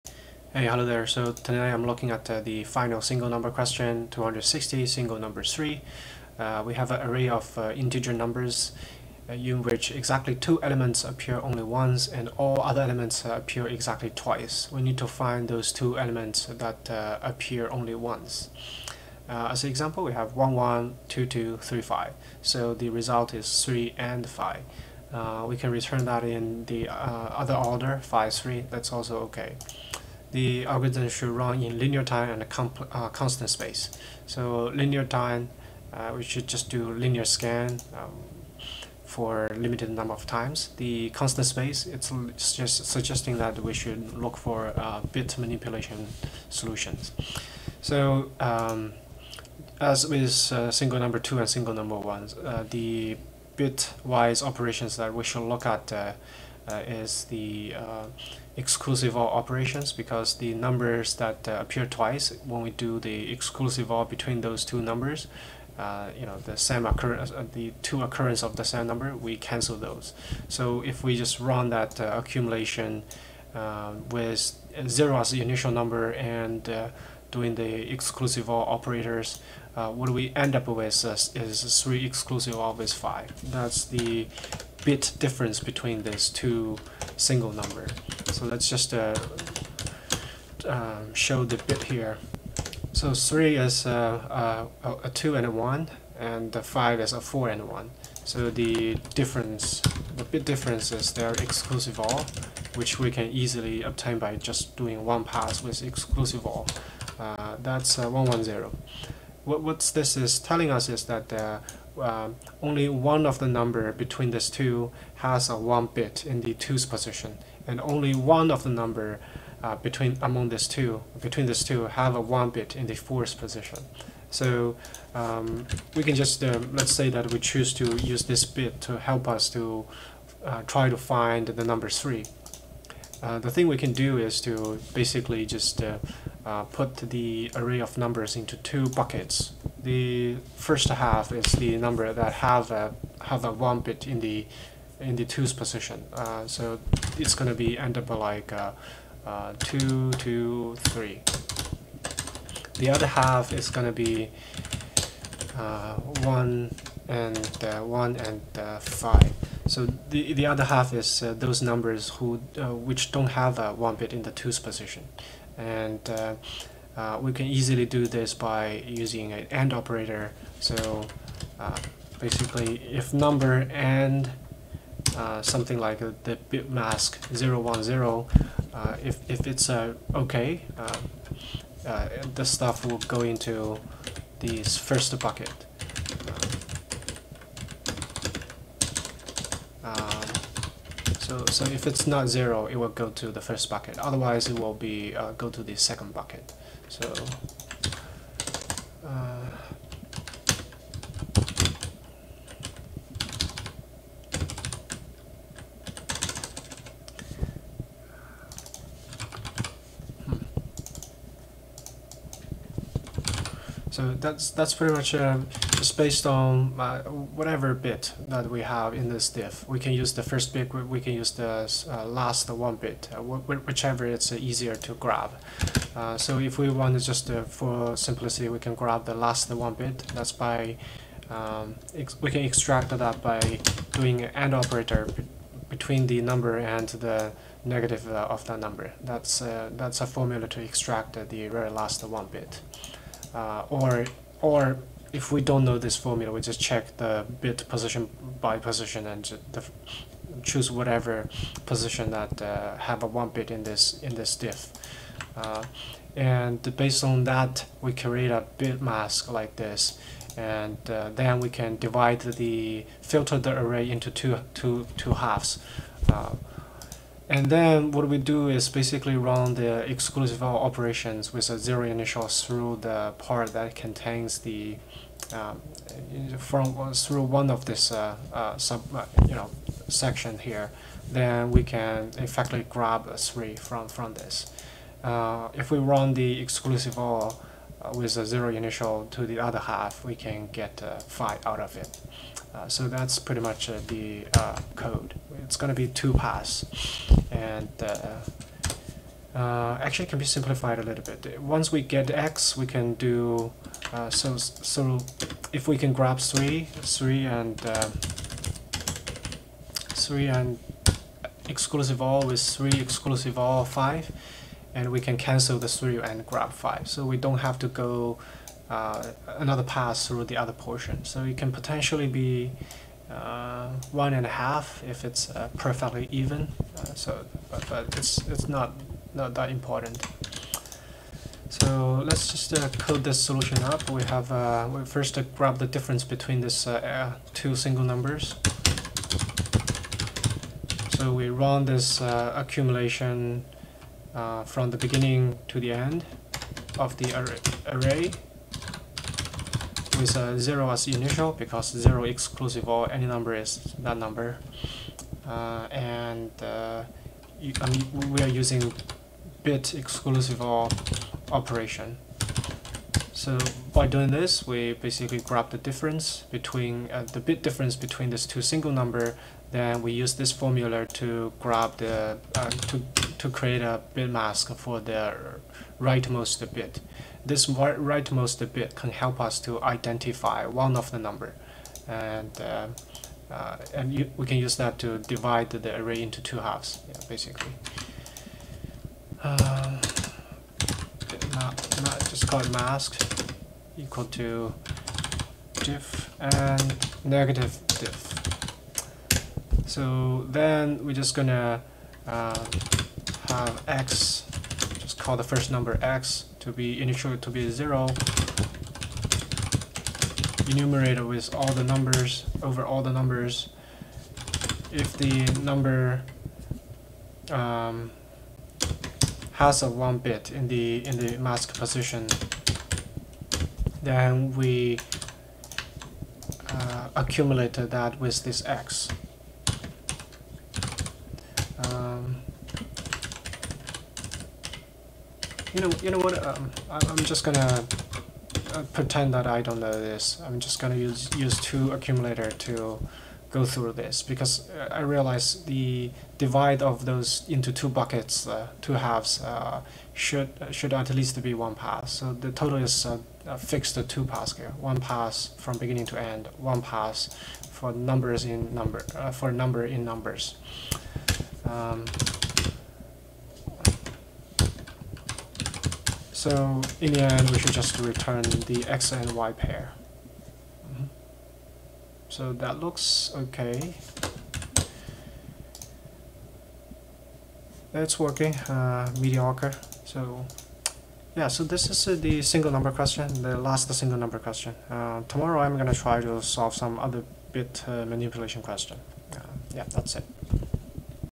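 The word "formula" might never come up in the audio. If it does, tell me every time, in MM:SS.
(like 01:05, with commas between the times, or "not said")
04:00, 04:05, 06:10.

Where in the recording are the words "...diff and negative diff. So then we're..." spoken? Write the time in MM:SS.
06:35.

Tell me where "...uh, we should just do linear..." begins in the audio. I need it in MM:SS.
00:35.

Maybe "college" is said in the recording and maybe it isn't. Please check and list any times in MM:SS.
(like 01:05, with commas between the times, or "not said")
not said.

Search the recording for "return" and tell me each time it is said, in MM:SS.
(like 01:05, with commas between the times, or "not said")
00:25, 07:47.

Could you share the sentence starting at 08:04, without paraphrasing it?
Uh, tomorrow I'm gonna try to solve some other bit uh, manipulation question.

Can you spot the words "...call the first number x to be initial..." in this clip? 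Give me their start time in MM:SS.
06:44.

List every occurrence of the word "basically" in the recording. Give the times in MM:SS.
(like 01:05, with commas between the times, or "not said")
02:14, 02:52, 04:28, 06:04, 06:27.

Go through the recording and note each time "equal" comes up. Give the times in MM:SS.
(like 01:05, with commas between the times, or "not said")
06:33.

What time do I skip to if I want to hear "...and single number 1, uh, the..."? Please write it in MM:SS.
00:51.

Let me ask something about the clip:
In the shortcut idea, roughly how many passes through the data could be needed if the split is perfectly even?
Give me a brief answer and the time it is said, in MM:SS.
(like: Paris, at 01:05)
one and a half, at 05:23.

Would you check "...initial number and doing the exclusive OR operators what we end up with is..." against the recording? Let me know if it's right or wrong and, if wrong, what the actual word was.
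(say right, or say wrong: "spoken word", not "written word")
right.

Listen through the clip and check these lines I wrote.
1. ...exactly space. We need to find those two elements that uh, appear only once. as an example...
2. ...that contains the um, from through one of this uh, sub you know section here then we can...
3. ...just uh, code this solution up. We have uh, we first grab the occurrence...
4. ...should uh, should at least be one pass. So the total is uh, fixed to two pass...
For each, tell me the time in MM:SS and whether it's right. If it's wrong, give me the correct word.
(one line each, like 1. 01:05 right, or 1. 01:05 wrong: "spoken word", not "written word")
1. 00:13 wrong: "twice", not "space"
2. 04:33 right
3. 05:32 wrong: "difference", not "occurrence"
4. 07:29 right.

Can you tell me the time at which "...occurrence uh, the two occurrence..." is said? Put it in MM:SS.
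01:06.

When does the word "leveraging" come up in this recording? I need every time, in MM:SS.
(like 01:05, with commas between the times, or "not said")
not said.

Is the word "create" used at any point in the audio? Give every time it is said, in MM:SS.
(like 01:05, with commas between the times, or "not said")
04:17, 06:13.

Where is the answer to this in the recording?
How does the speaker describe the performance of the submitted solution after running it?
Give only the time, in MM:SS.
07:59.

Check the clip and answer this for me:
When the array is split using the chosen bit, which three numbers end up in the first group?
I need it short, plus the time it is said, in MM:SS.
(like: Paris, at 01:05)
2, 2, 3, at 02:29.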